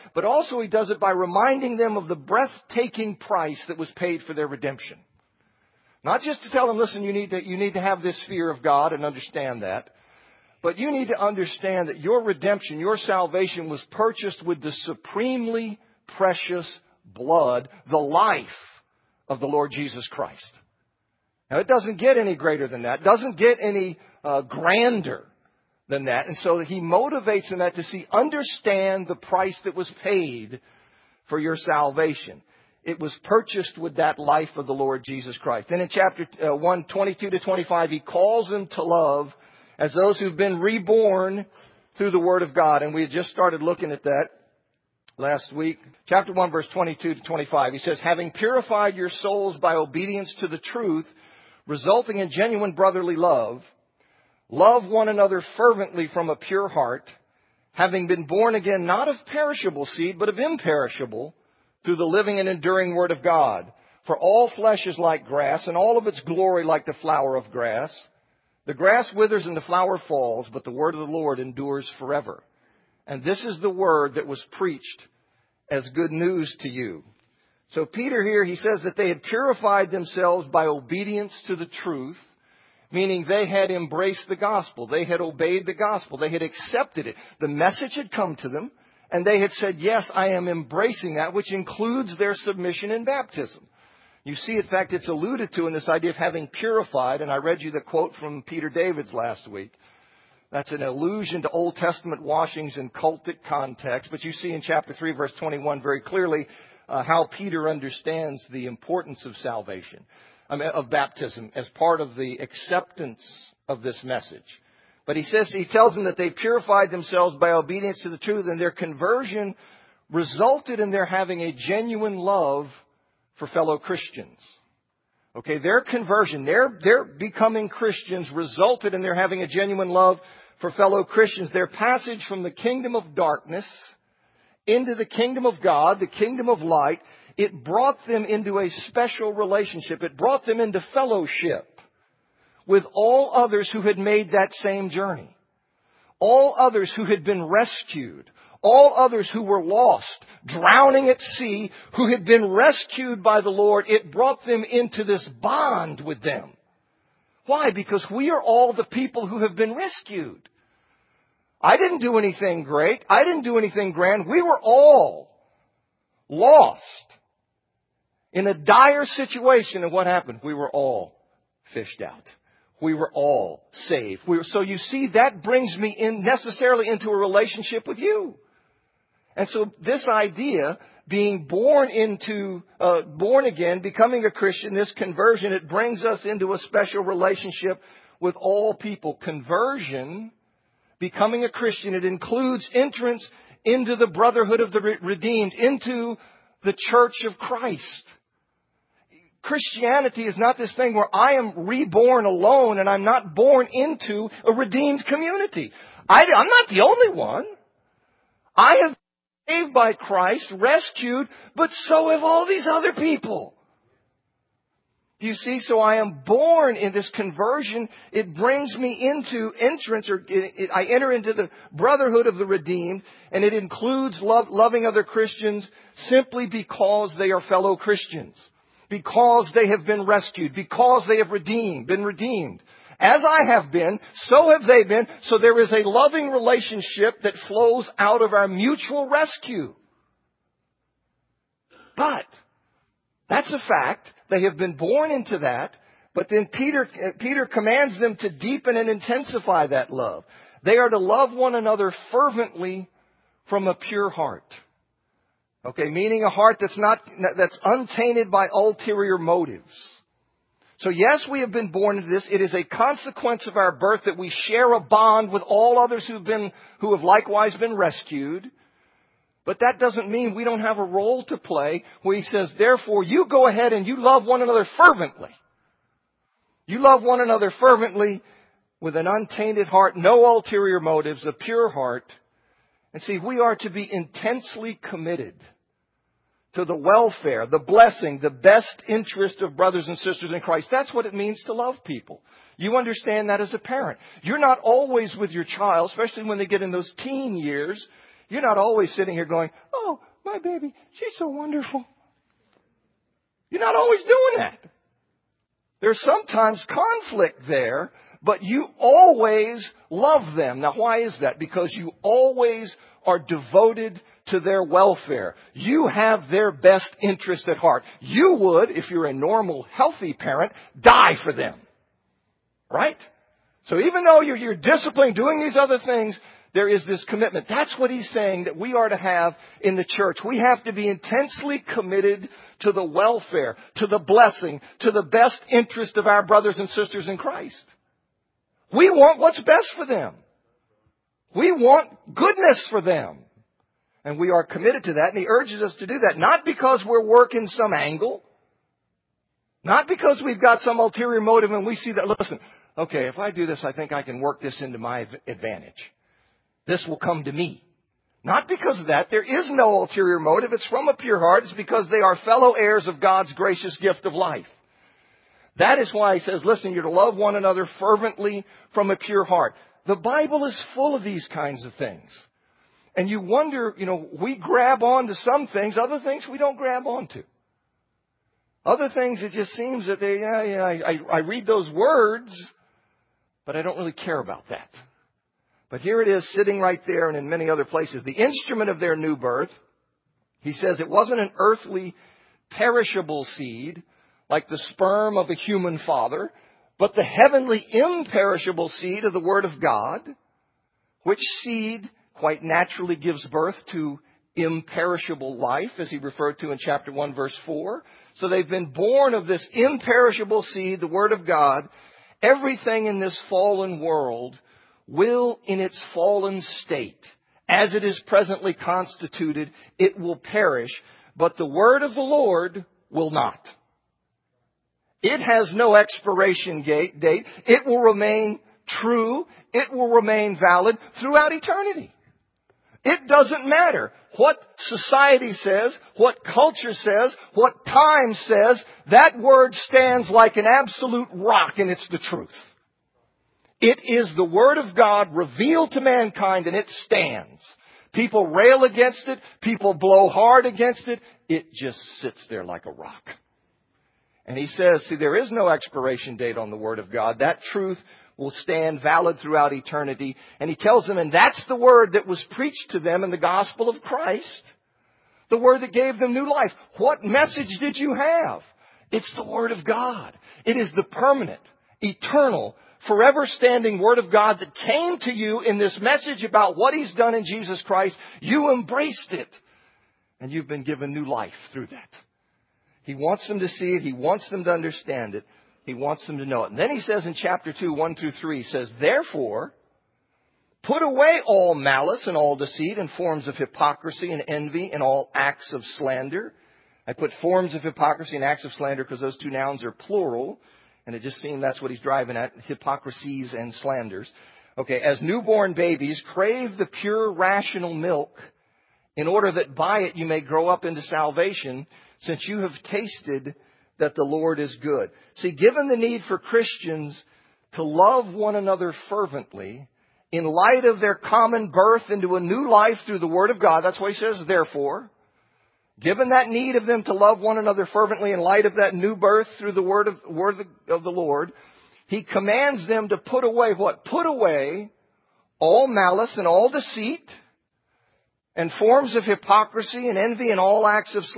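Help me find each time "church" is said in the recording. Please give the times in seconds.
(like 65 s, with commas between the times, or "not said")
196 s, 329 s.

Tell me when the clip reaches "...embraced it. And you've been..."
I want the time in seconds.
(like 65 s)
478 s.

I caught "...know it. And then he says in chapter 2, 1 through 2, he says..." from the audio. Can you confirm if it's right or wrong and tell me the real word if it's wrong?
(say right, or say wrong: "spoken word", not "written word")
wrong: "3", not "2".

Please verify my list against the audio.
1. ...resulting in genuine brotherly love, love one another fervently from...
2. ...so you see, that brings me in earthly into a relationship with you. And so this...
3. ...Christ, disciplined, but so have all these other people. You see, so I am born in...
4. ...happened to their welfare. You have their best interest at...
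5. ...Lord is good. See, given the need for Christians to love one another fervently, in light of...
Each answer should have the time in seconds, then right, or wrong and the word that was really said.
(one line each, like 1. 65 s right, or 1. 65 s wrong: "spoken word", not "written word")
1. 51 s right
2. 174 s wrong: "necessarily", not "earthly"
3. 209 s wrong: "rescued", not "disciplined"
4. 313 s wrong: "devoted", not "happened"
5. 514 s right.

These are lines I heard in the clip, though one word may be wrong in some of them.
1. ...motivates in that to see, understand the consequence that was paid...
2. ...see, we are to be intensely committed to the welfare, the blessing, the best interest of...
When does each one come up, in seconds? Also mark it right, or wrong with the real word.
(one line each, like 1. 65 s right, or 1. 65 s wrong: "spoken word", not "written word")
1. 26 s wrong: "price", not "consequence"
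2. 283 s right.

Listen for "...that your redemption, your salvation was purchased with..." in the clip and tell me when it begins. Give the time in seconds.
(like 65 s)
11 s.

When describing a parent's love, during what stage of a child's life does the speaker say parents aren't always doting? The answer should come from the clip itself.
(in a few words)
teen years.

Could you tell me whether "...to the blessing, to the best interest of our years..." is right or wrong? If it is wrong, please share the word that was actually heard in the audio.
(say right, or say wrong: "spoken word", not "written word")
wrong: "brothers", not "years".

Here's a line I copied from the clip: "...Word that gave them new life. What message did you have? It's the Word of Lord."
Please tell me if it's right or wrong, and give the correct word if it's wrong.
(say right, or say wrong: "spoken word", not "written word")
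wrong: "God", not "Lord".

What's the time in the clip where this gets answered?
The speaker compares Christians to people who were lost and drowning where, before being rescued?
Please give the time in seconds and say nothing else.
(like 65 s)
150 s.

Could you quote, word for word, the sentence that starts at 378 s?
Other things, it just seems that they, yeah, yeah, I, I read those words, but I don't really care about that.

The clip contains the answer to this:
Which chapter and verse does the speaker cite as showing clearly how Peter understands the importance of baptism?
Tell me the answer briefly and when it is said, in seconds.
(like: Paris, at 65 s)
Chapter 3, verse 21, at 104 s.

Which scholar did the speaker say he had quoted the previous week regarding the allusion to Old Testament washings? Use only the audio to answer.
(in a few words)
Peter Davids.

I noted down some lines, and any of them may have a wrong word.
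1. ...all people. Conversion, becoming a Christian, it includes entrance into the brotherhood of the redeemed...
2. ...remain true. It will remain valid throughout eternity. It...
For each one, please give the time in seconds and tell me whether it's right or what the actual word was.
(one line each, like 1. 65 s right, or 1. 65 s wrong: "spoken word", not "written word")
1. 188 s right
2. 427 s right.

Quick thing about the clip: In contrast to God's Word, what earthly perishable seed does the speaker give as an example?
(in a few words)
sperm of a human father.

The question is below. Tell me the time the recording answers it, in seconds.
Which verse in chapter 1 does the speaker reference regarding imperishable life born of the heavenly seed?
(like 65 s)
406 s.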